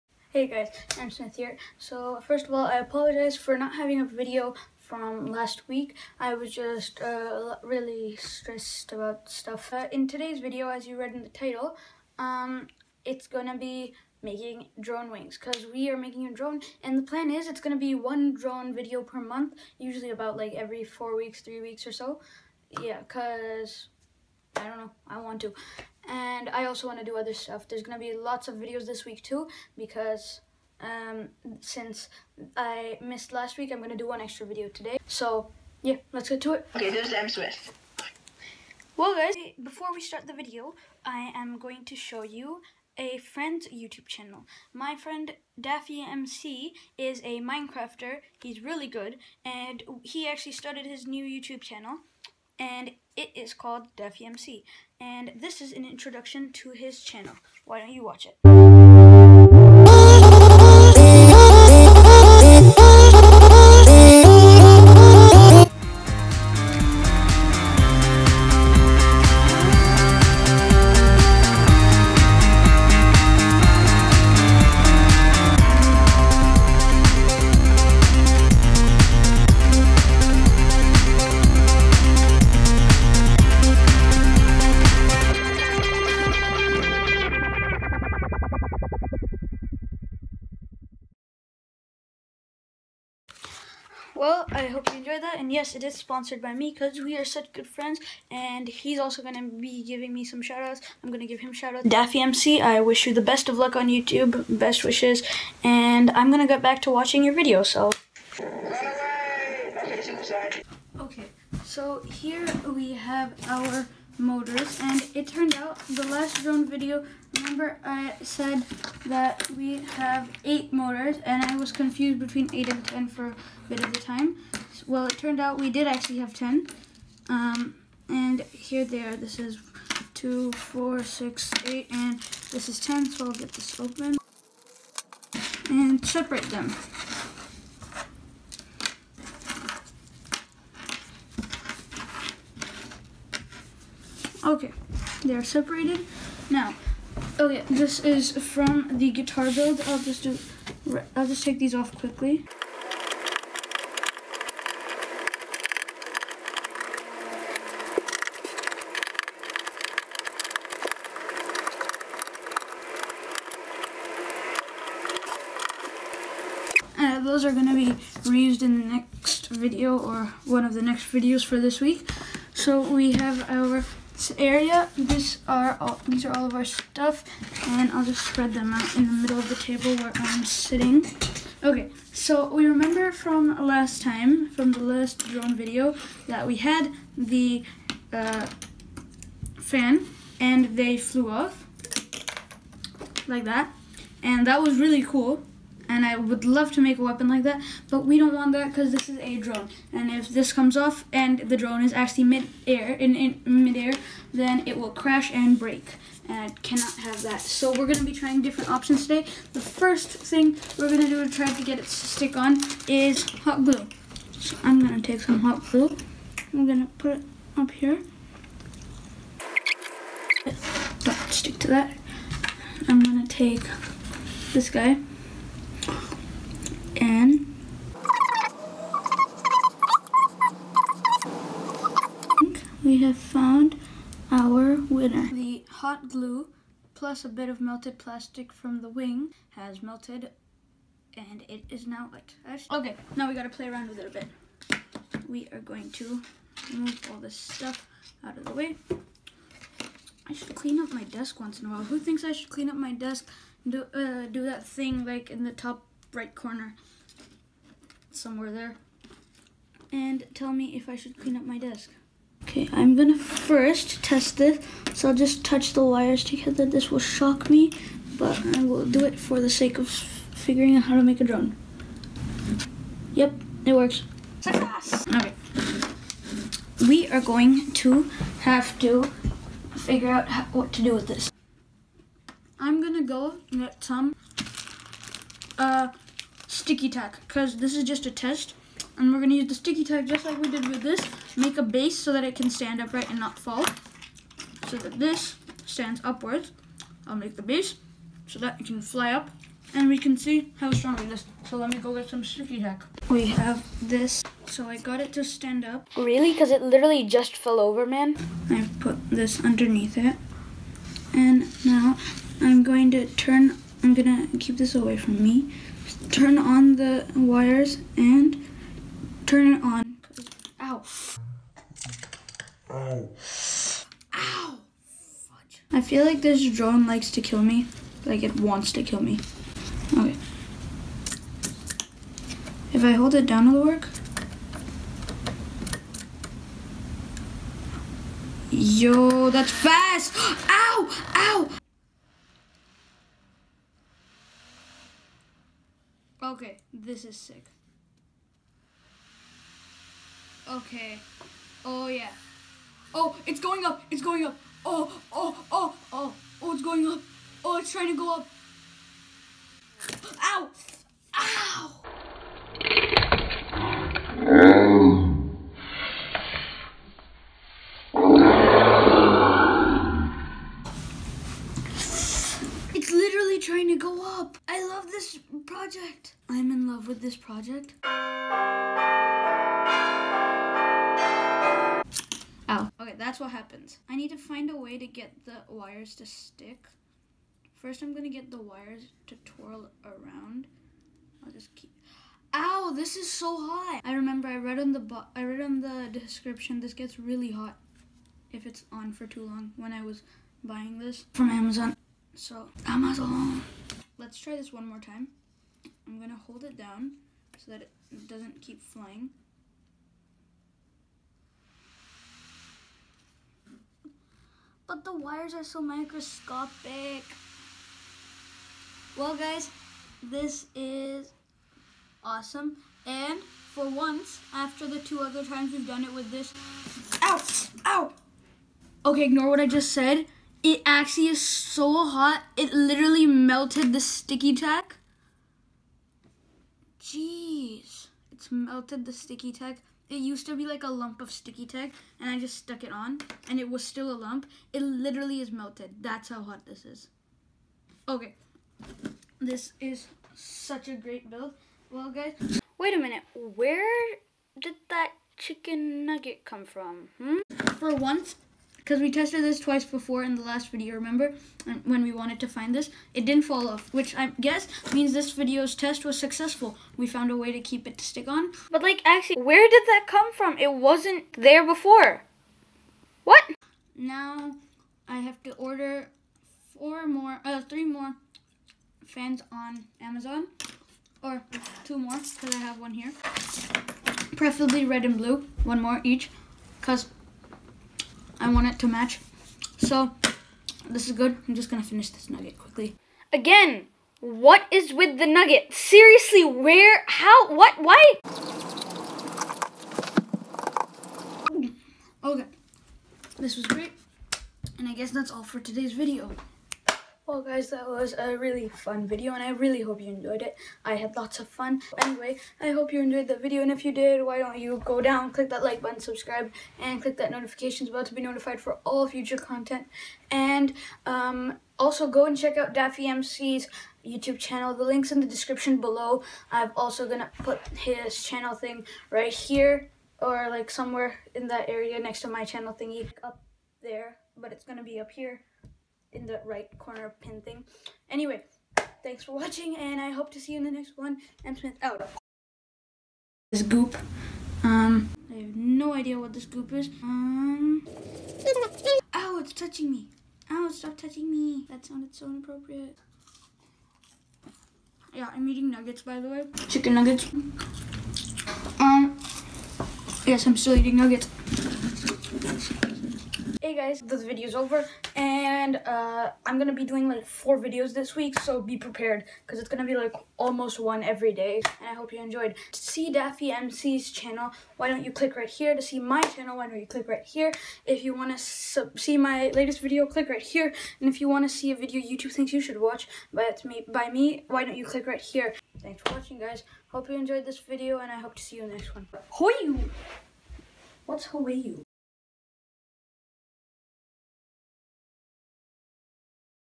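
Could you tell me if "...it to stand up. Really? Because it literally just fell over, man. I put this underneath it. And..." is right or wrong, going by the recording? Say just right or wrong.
right.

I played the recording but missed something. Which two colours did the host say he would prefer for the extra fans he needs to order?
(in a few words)
Red and blue.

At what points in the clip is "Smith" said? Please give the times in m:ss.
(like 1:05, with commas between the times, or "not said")
0:01, 0:37, 9:01.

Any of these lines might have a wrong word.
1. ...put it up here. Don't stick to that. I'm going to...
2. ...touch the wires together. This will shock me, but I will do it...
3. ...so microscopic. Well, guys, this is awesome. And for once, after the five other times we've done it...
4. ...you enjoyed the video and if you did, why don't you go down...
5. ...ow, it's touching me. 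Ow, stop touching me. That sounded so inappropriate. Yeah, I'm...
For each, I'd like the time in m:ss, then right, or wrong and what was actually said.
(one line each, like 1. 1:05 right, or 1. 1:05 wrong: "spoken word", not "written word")
1. 3:36 right
2. 4:25 right
3. 6:55 wrong: "two", not "five"
4. 8:32 right
5. 9:08 right.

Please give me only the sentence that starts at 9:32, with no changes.
To see Daffy MC's channel, why don't you click right here?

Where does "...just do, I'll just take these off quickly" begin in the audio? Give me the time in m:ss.
2:29.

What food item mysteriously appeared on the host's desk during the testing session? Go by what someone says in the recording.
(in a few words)
Chicken nugget.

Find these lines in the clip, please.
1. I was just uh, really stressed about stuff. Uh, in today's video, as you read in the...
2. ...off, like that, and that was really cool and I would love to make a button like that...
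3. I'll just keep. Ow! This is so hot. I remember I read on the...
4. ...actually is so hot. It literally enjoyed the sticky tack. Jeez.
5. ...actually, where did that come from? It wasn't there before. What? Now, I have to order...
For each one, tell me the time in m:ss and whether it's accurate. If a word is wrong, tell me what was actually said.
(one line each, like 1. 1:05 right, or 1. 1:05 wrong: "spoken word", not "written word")
1. 0:06 right
2. 3:11 wrong: "weapon", not "button"
3. 6:31 right
4. 7:10 wrong: "melted", not "enjoyed"
5. 7:48 right.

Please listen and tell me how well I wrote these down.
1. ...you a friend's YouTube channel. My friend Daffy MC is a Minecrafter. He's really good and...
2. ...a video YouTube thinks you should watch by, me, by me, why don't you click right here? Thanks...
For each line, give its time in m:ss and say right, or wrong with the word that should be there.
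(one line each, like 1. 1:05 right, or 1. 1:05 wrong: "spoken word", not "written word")
1. 0:42 right
2. 9:41 right.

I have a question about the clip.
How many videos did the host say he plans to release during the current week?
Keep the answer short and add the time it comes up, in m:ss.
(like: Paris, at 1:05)
4, at 9:27.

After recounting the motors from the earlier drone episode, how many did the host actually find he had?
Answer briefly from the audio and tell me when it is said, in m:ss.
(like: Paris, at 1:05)
10, at 2:05.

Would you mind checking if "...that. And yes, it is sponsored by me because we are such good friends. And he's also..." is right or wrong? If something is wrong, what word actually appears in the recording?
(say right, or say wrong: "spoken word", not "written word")
right.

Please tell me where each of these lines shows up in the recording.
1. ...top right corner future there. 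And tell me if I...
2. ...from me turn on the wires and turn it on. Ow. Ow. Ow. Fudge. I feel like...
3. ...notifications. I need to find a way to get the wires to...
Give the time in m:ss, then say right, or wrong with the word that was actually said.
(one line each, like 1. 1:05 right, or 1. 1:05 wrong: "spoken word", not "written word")
1. 4:15 wrong: "somewhere", not "future"
2. 5:14 right
3. 6:23 wrong: "happens", not "notifications".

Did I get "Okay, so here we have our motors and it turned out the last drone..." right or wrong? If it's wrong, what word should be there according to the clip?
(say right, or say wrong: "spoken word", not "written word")
right.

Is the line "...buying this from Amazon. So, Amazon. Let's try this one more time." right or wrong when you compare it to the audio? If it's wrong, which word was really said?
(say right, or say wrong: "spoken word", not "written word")
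right.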